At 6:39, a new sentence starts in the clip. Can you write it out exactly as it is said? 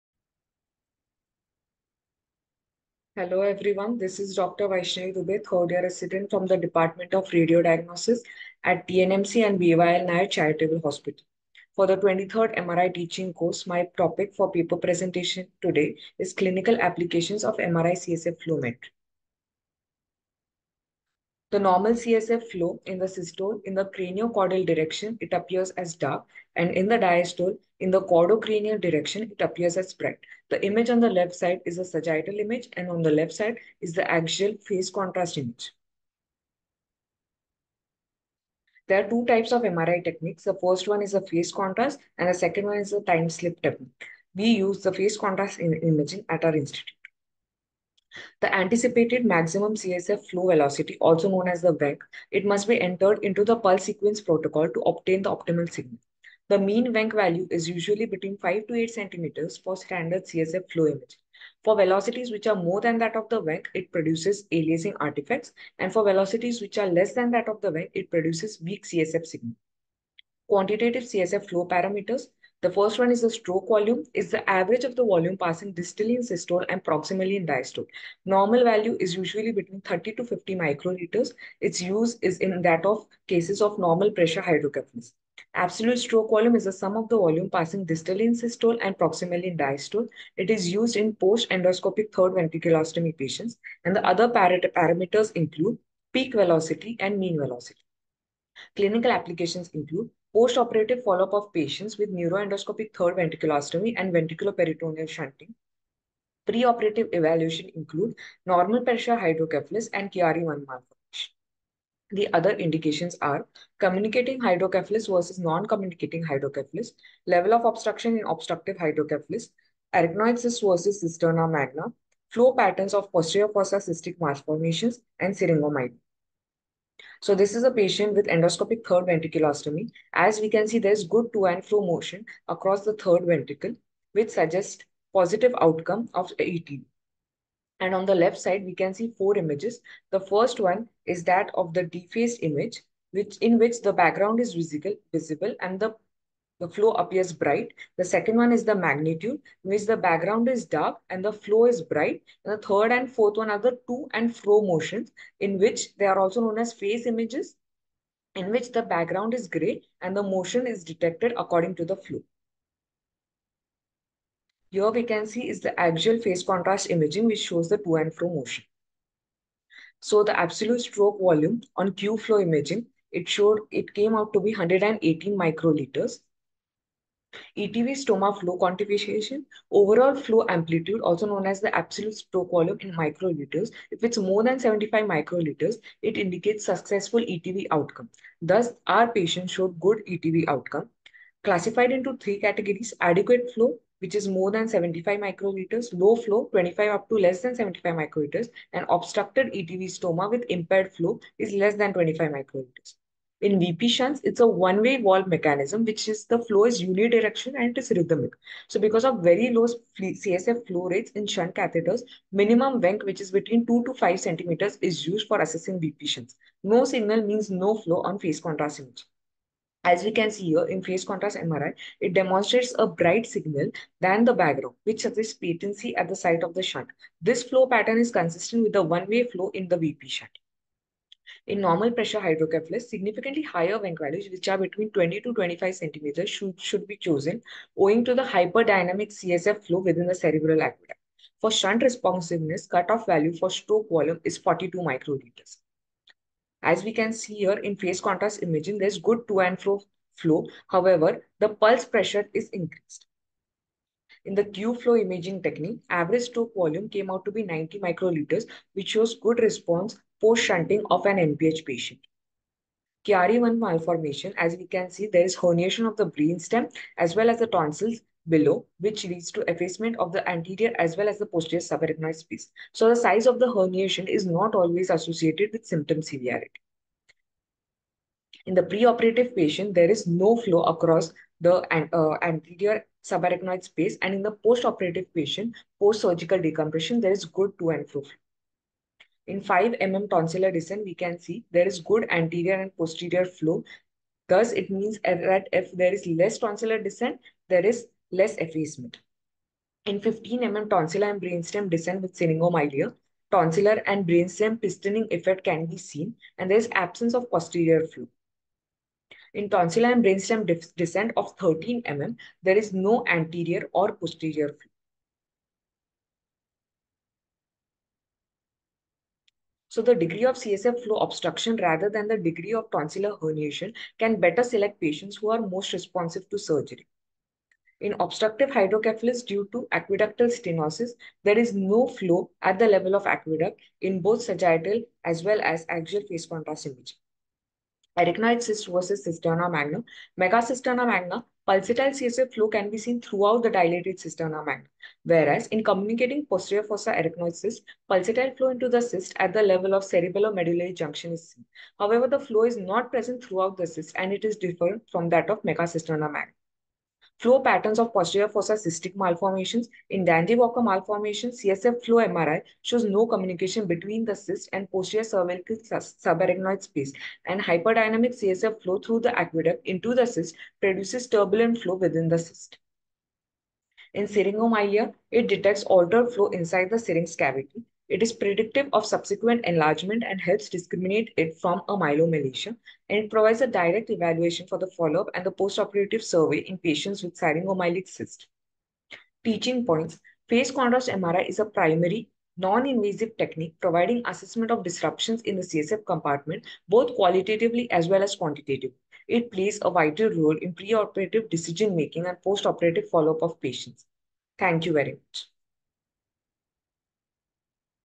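It plays a vital role in preoperative decision-making and postoperative follow-up of patients.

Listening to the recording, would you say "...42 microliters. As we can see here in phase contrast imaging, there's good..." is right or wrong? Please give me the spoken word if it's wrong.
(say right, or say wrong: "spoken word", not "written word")
right.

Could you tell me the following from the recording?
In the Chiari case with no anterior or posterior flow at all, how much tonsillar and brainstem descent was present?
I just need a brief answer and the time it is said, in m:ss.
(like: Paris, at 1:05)
13 mm, at 5:11.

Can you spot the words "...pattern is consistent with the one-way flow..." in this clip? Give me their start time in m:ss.
3:47.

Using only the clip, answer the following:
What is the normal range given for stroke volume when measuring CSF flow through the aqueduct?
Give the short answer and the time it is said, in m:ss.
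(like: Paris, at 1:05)
30 to 50 microliters, at 1:19.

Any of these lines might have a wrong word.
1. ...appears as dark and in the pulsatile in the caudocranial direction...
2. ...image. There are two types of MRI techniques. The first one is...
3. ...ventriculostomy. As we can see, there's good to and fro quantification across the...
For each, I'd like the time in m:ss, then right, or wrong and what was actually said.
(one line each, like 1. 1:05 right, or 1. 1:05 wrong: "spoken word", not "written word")
1. 0:25 wrong: "diastole", not "pulsatile"
2. 0:35 right
3. 2:09 wrong: "motion", not "quantification".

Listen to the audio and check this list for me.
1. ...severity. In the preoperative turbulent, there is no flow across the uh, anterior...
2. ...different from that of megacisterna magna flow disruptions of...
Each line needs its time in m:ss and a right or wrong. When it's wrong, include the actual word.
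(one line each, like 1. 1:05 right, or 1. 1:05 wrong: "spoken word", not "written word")
1. 4:36 wrong: "patient", not "turbulent"
2. 5:54 wrong: "patterns", not "disruptions".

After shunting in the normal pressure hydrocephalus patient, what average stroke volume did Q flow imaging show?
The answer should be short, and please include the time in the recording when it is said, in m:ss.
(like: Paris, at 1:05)
90 microliters, at 4:17.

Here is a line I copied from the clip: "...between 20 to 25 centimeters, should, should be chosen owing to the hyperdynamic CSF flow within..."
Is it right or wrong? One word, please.
right.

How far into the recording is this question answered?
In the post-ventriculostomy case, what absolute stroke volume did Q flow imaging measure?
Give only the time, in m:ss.
2:54.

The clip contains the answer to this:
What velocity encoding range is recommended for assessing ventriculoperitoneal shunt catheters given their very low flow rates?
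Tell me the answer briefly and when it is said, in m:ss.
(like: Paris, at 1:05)
2 to 5 centimeters, at 3:33.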